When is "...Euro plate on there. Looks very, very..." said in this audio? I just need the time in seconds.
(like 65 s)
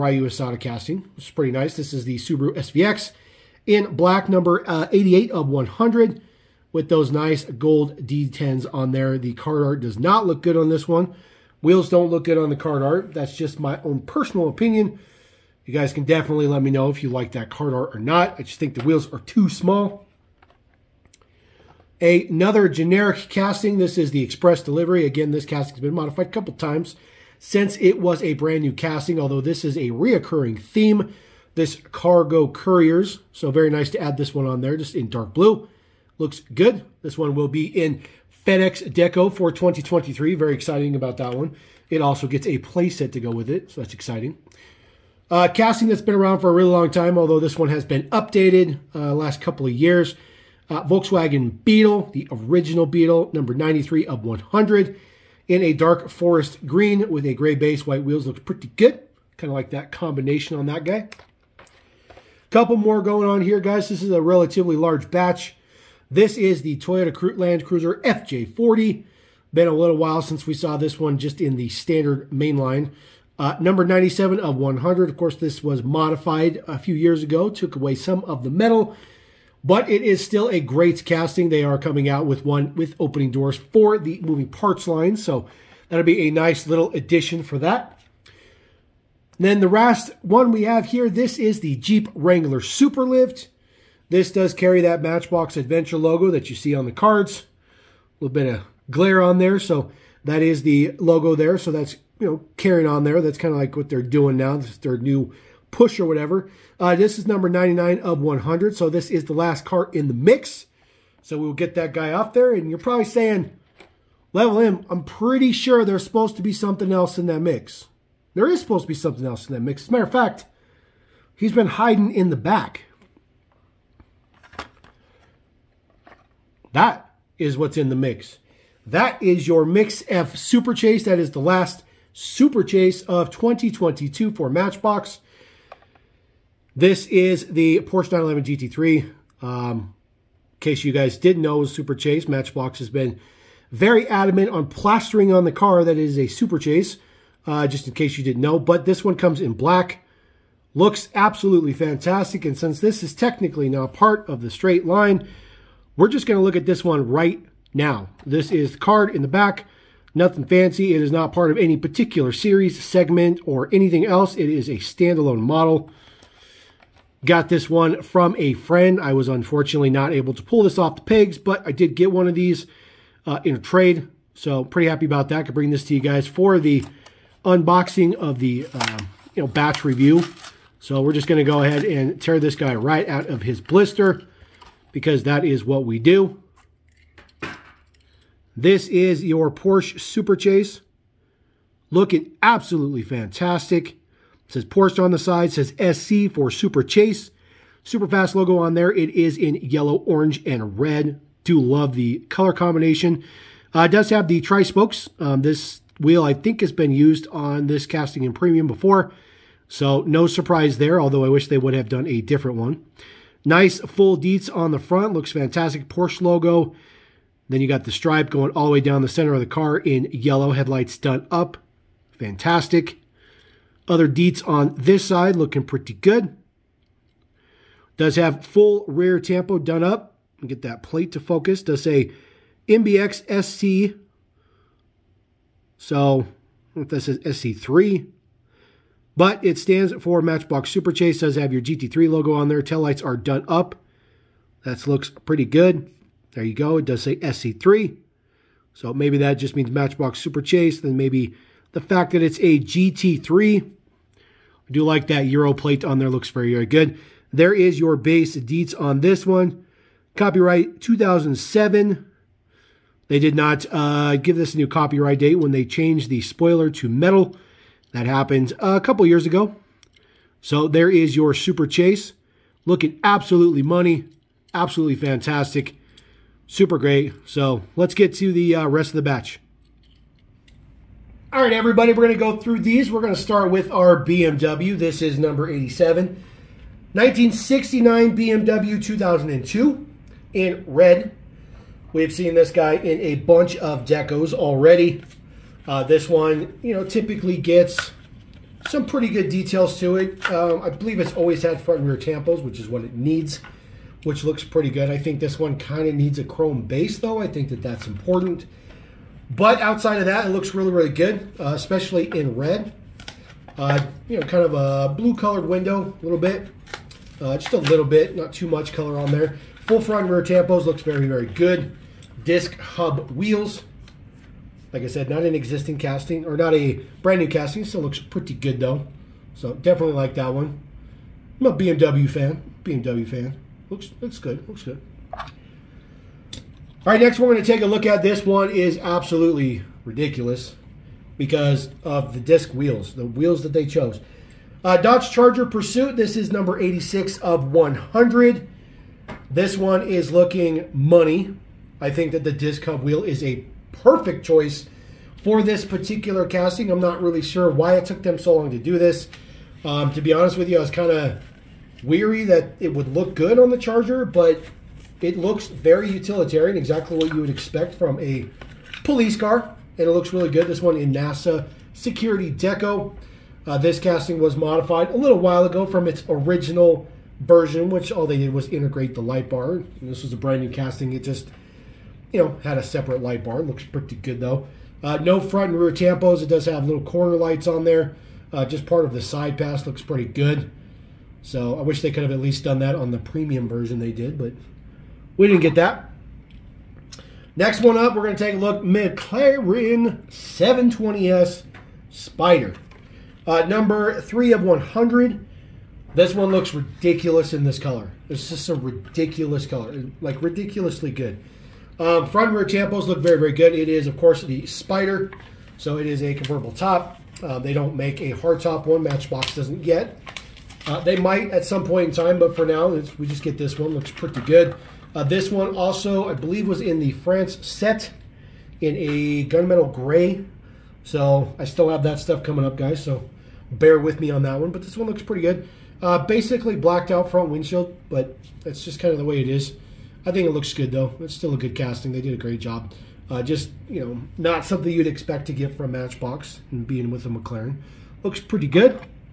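255 s.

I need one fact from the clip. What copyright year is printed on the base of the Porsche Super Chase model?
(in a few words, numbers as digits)
2007.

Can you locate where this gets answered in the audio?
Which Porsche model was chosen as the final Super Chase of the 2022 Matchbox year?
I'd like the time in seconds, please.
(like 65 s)
137 s.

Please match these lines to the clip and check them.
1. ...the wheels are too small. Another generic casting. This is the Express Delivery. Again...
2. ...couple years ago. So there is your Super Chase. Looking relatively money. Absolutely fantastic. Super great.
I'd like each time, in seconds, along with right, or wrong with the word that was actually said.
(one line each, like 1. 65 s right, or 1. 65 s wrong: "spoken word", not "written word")
1. 18 s right
2. 268 s wrong: "absolutely", not "relatively".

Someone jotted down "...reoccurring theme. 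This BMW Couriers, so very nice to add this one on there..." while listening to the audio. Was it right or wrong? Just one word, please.
wrong.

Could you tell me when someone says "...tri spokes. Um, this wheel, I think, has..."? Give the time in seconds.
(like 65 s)
204 s.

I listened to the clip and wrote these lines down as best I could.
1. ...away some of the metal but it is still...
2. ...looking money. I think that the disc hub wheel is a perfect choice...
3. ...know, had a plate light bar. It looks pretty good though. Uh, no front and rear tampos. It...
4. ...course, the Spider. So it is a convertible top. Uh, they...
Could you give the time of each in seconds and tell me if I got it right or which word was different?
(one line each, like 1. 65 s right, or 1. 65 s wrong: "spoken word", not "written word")
1. 77 s right
2. 350 s right
3. 382 s wrong: "separate", not "plate"
4. 413 s right.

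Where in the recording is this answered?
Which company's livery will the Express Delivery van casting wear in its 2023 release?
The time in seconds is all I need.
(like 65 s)
38 s.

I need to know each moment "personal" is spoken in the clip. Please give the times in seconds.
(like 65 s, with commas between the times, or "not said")
14 s.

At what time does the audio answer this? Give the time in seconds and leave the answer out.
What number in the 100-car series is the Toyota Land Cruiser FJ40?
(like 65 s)
73 s.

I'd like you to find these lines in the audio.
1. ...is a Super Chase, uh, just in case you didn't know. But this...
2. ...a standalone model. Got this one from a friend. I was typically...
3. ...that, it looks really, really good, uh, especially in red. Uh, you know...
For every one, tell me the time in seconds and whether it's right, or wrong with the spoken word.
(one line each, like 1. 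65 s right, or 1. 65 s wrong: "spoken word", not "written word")
1. 145 s right
2. 164 s wrong: "unfortunately", not "typically"
3. 310 s right.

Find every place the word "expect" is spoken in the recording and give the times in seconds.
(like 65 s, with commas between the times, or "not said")
367 s, 444 s.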